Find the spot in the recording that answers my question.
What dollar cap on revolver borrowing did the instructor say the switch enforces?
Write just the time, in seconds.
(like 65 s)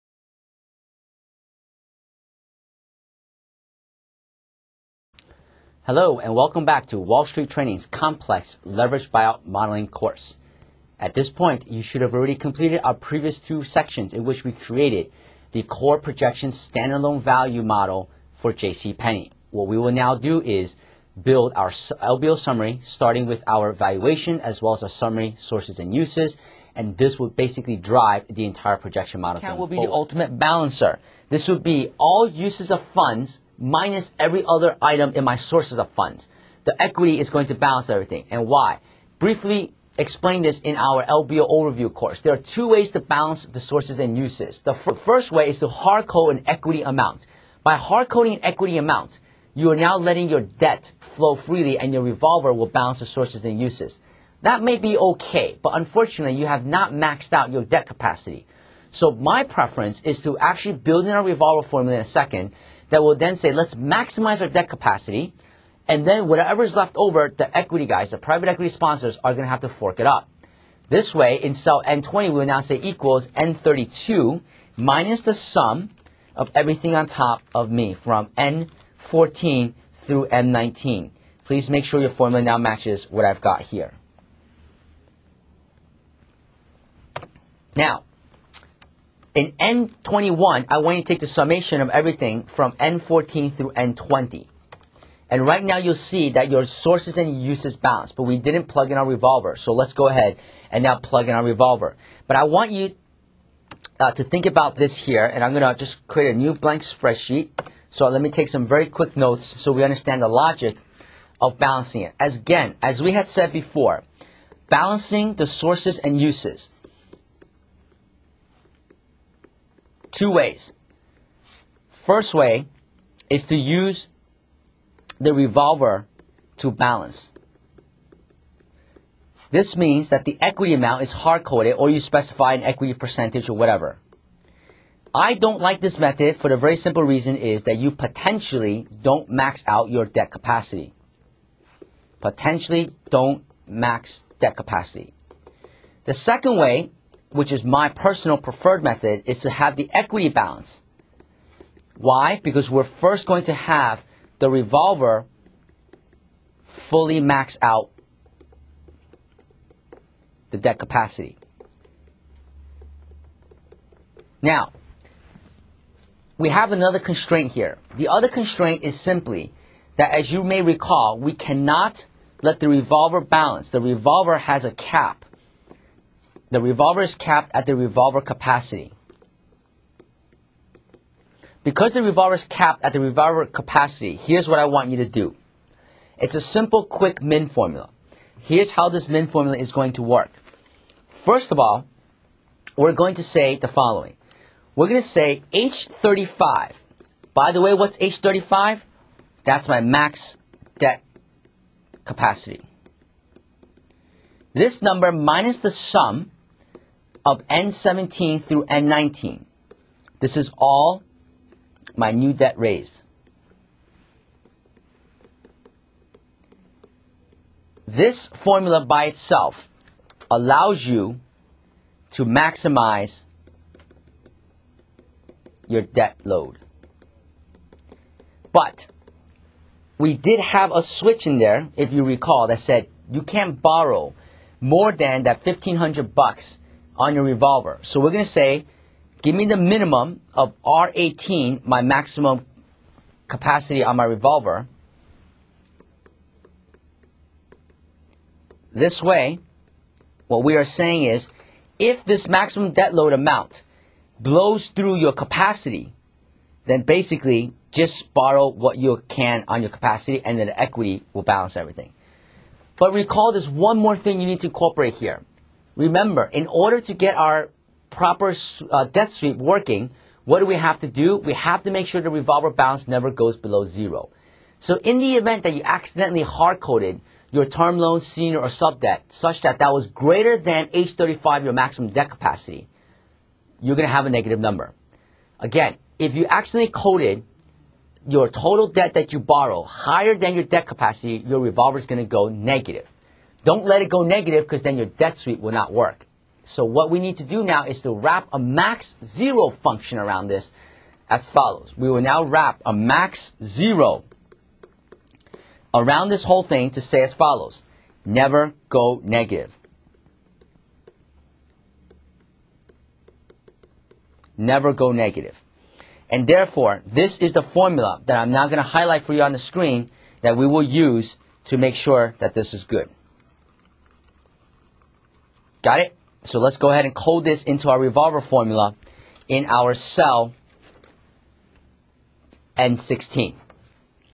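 235 s.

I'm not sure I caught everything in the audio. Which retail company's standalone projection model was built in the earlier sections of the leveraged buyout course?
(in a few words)
J.C. Penney.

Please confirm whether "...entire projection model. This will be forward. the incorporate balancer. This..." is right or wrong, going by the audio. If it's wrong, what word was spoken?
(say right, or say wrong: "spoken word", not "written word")
wrong: "ultimate", not "incorporate".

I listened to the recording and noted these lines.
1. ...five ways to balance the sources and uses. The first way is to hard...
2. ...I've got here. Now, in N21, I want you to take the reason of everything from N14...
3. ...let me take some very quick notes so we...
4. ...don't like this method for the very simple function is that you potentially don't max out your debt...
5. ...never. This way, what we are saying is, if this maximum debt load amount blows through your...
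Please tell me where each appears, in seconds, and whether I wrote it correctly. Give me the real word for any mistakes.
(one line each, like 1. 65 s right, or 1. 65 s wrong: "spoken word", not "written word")
1. 42 s wrong: "two", not "five"
2. 83 s wrong: "summation", not "reason"
3. 108 s right
4. 135 s wrong: "reason", not "function"
5. 244 s wrong: "revolver", not "never".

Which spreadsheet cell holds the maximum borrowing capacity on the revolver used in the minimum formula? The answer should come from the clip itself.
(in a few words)
R18.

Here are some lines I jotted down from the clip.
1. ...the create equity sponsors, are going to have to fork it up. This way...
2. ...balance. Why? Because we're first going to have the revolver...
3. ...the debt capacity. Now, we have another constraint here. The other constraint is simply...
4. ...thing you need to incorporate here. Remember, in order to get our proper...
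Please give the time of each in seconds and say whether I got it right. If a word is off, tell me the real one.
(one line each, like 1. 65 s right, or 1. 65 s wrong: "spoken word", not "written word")
1. 68 s wrong: "private", not "create"
2. 150 s right
3. 160 s right
4. 263 s right.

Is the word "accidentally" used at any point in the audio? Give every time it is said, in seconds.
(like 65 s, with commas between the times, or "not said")
275 s, 286 s.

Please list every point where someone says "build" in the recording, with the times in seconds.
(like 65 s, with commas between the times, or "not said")
21 s, 60 s.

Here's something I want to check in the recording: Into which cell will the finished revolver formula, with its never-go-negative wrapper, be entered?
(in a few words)
N16.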